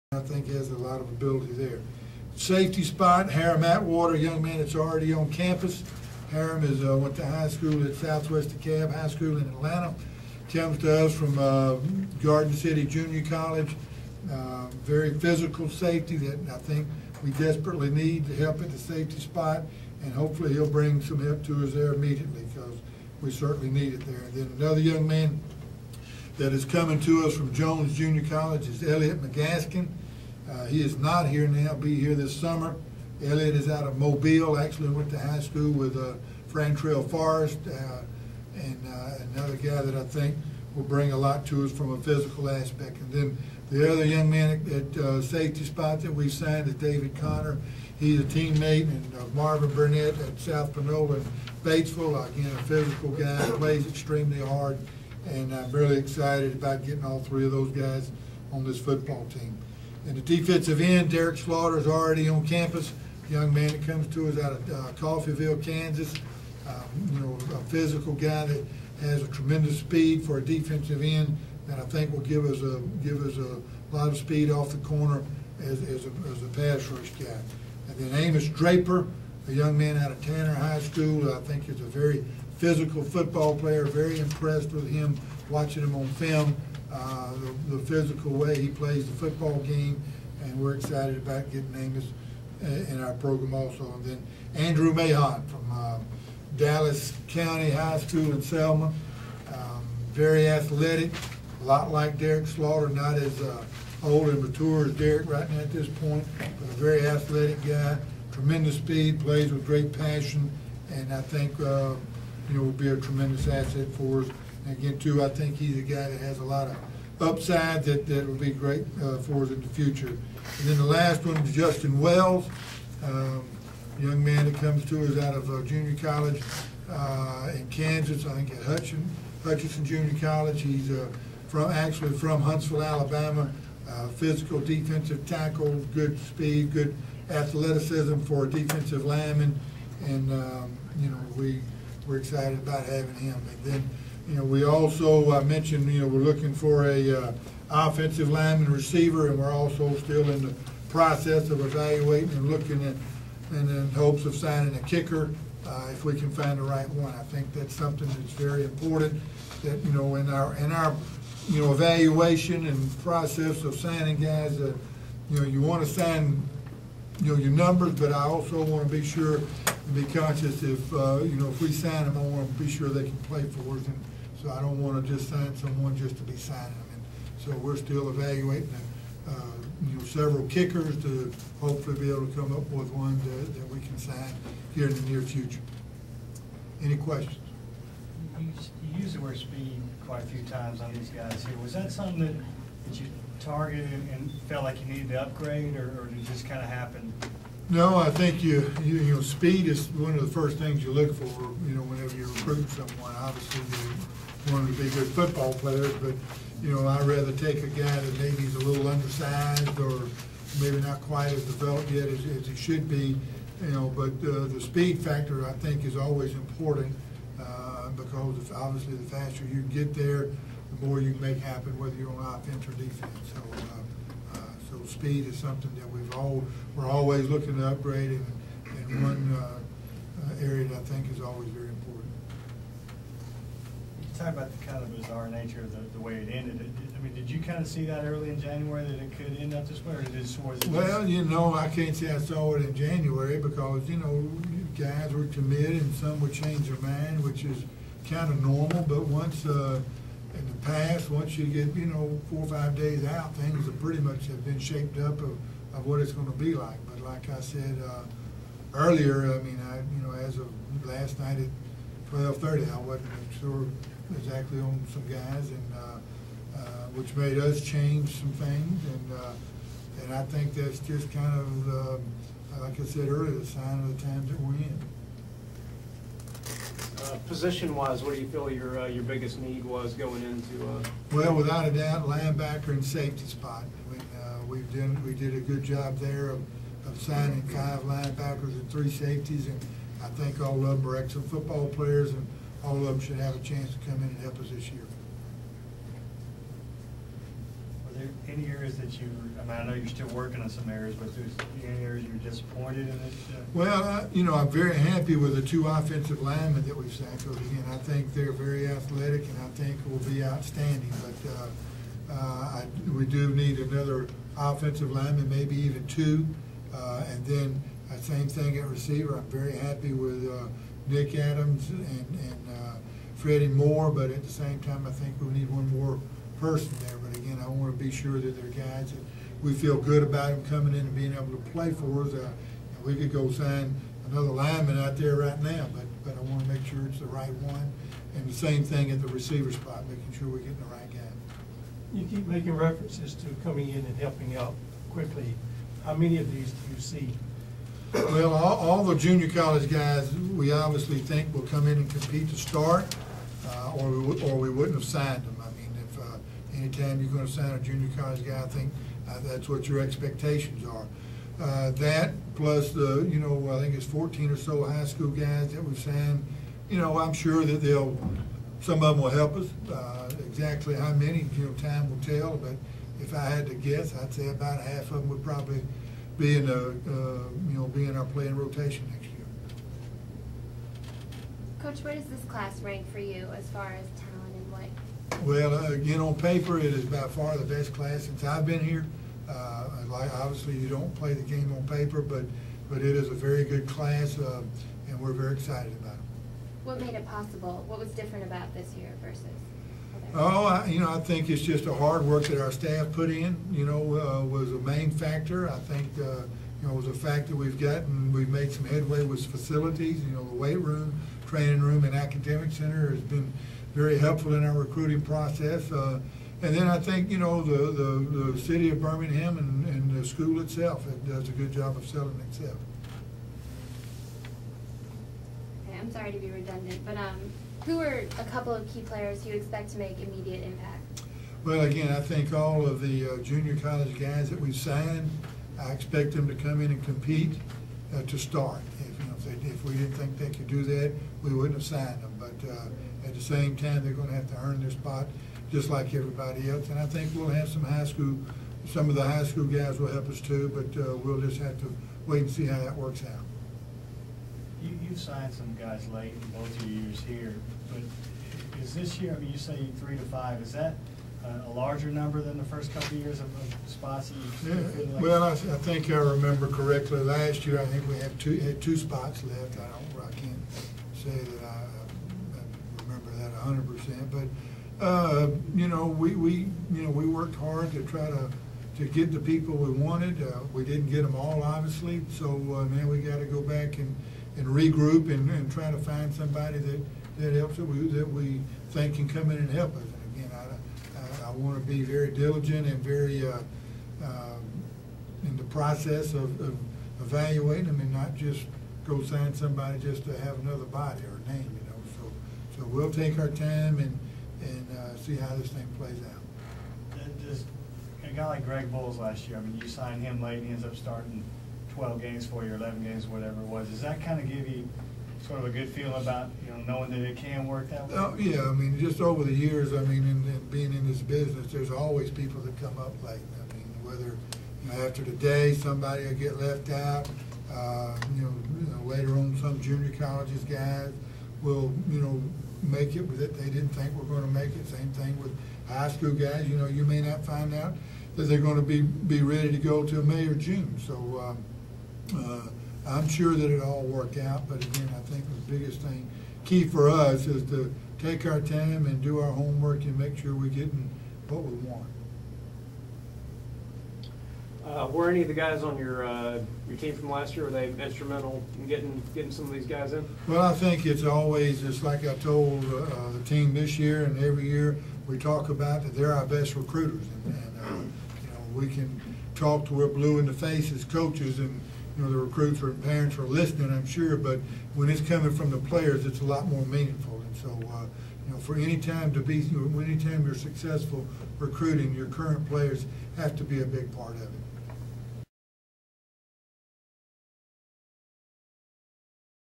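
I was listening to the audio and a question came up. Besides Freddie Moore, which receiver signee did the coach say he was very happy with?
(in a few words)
Nick Adams.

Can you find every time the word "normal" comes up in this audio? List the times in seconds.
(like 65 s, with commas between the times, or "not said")
248 s.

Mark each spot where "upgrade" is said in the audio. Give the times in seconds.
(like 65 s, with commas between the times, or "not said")
195 s, 227 s.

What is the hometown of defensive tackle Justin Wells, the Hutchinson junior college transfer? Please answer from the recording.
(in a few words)
Huntsville, Alabama.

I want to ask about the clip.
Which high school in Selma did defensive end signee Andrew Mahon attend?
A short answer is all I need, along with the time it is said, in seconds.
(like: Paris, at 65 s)
Dallas County High School, at 96 s.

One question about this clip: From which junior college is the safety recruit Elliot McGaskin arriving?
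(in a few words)
Jones Junior College.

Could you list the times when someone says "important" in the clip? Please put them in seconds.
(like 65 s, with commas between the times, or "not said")
158 s, 216 s, 231 s.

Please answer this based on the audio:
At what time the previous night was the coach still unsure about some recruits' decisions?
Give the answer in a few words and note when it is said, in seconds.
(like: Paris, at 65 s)
12:30, at 262 s.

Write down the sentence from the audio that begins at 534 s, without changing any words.
Same thing with high school guys.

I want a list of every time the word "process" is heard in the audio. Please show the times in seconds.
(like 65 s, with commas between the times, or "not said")
150 s, 163 s, 414 s, 495 s.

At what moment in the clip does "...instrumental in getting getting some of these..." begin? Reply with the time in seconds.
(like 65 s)
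557 s.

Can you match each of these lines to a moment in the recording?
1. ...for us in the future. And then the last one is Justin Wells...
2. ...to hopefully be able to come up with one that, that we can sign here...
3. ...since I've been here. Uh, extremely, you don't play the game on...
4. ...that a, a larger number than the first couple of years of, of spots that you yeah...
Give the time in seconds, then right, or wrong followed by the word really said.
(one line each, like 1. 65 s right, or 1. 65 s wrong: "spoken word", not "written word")
1. 119 s right
2. 181 s right
3. 388 s wrong: "obviously", not "extremely"
4. 460 s right.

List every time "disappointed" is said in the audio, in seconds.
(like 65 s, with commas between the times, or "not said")
302 s.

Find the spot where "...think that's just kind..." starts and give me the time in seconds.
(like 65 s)
270 s.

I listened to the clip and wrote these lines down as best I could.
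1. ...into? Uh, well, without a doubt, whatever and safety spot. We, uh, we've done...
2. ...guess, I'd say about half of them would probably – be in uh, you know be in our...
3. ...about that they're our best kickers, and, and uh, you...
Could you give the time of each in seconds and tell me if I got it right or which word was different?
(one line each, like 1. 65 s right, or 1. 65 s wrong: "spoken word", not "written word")
1. 280 s wrong: "linebacker", not "whatever"
2. 373 s right
3. 565 s wrong: "recruiters", not "kickers".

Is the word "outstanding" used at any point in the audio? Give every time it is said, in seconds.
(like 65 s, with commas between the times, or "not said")
310 s.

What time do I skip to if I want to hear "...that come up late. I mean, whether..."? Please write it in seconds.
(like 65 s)
522 s.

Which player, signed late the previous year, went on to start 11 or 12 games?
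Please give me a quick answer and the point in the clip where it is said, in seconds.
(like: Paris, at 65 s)
Greg Bowles, at 508 s.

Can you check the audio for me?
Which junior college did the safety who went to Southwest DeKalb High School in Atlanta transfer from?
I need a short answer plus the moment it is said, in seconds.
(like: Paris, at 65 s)
Garden City Junior College, at 12 s.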